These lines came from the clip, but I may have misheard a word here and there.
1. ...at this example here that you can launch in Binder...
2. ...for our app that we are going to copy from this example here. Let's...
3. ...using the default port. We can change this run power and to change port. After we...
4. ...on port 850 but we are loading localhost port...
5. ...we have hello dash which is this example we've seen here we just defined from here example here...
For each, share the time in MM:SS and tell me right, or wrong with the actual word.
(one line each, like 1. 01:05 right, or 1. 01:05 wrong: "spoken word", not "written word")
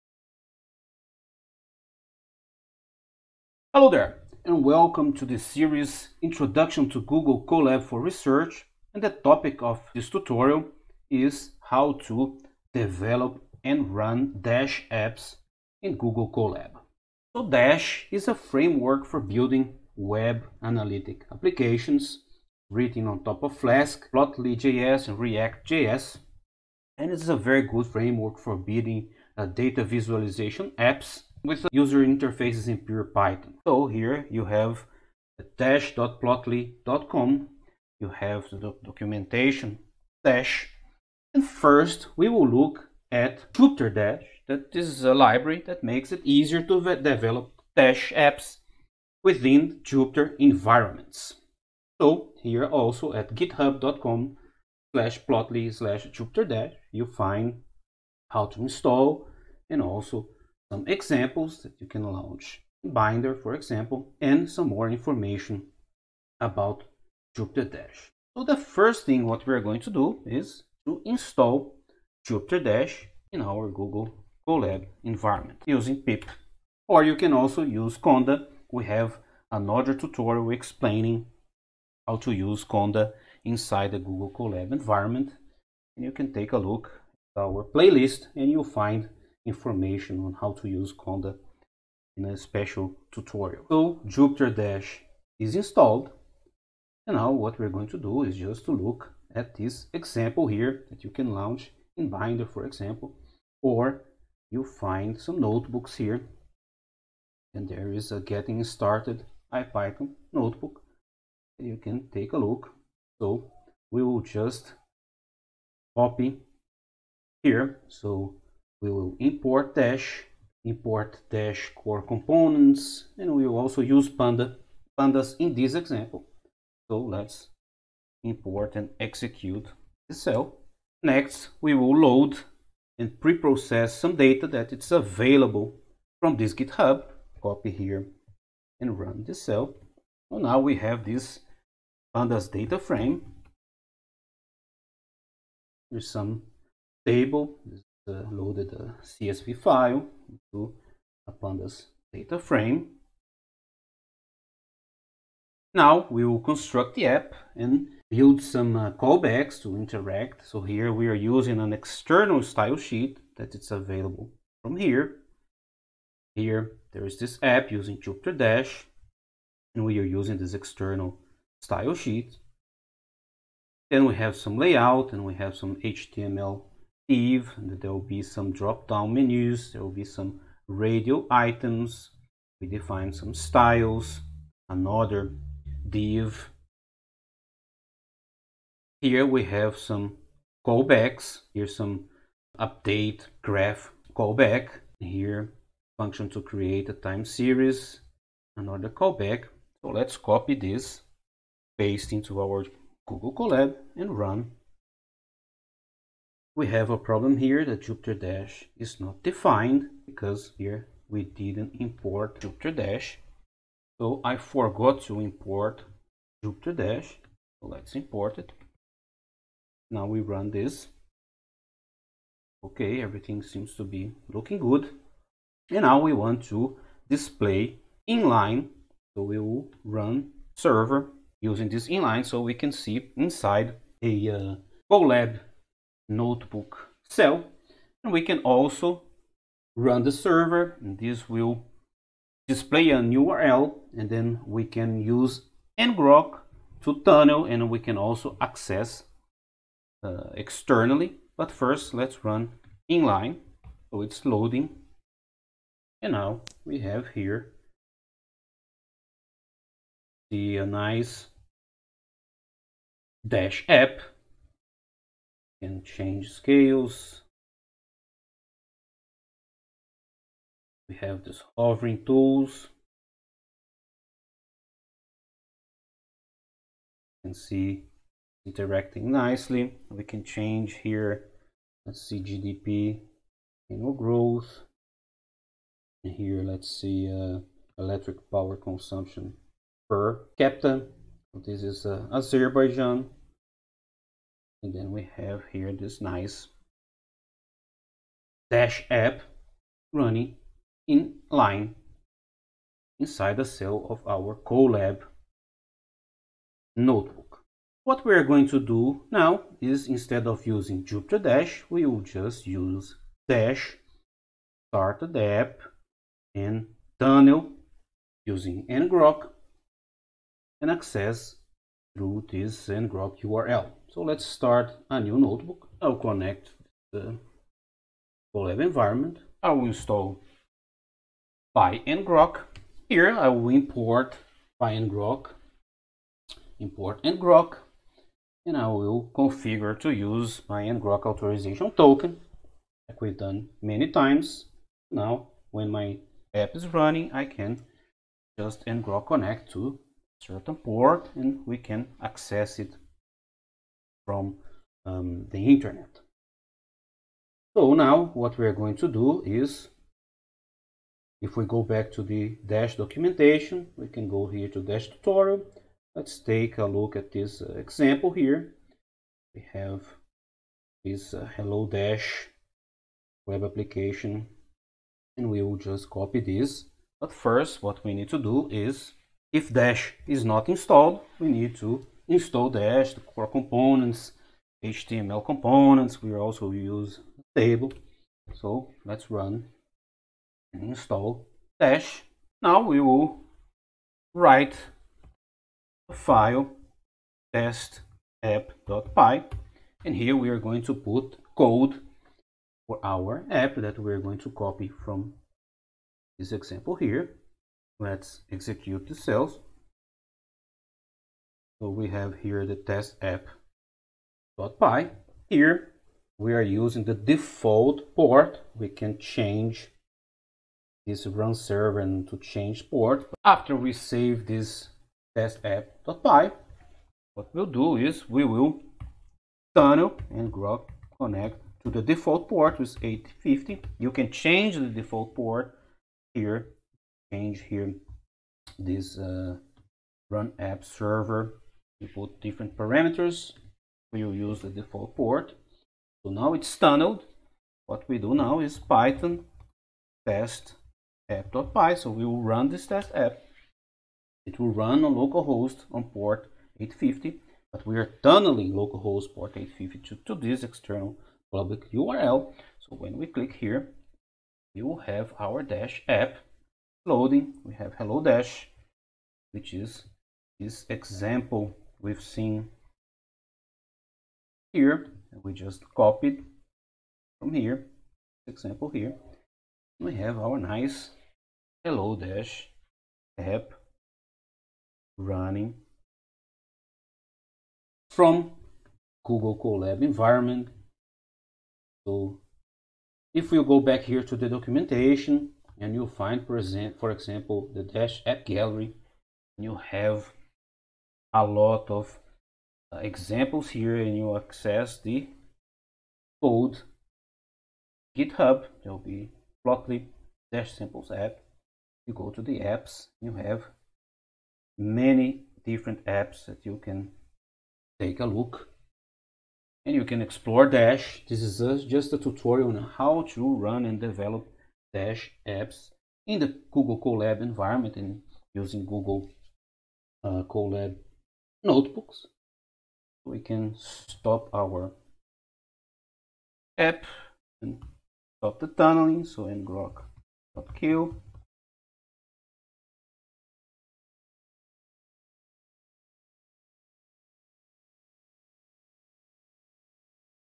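1. 01:39 right
2. 06:42 right
3. 06:56 wrong: "server", not "power"
4. 07:35 wrong: "tunneling", not "loading"
5. 07:47 wrong: "copied", not "defined".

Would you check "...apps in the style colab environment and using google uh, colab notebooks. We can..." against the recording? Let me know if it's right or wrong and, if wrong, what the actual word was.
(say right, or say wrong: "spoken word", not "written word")
wrong: "google", not "style".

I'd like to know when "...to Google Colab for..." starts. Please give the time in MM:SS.
00:06.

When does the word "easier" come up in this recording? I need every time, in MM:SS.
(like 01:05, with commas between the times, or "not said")
00:46.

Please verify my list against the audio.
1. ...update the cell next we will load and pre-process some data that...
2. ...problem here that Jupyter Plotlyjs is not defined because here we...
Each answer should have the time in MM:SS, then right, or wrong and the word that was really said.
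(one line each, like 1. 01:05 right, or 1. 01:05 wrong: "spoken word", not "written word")
1. 02:08 wrong: "execute", not "update"
2. 03:26 wrong: "Dash", not "Plotlyjs".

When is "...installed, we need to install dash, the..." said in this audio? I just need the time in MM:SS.
06:20.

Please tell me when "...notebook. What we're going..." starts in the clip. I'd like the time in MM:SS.
05:06.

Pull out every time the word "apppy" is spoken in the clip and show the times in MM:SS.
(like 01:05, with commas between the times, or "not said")
06:38, 06:53, 07:05, 07:31.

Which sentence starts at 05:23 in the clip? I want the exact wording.
So let's start a new notebook.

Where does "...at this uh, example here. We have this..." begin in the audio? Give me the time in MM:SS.
06:06.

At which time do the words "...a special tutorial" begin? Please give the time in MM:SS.
01:32.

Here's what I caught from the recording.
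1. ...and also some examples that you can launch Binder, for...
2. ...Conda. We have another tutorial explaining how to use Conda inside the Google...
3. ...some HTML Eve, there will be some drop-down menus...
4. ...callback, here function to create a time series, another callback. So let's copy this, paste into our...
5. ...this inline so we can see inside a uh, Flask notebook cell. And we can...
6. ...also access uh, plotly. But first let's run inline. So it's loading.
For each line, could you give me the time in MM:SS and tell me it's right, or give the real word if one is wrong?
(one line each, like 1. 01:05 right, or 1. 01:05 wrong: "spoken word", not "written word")
1. 00:59 right
2. 01:17 right
3. 02:55 right
4. 03:14 right
5. 03:51 wrong: "Colab", not "Flask"
6. 04:07 wrong: "externally", not "plotly".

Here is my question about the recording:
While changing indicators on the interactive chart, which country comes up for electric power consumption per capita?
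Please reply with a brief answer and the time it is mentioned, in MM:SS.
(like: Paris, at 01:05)
Azerbaijan, at 04:52.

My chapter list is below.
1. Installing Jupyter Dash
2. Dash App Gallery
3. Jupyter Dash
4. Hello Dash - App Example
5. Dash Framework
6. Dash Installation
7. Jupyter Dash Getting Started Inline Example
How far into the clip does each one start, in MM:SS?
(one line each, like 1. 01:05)
1. 01:13
2. 08:17
3. 00:43
4. 06:36
5. 00:17
6. 05:07
7. 02:06.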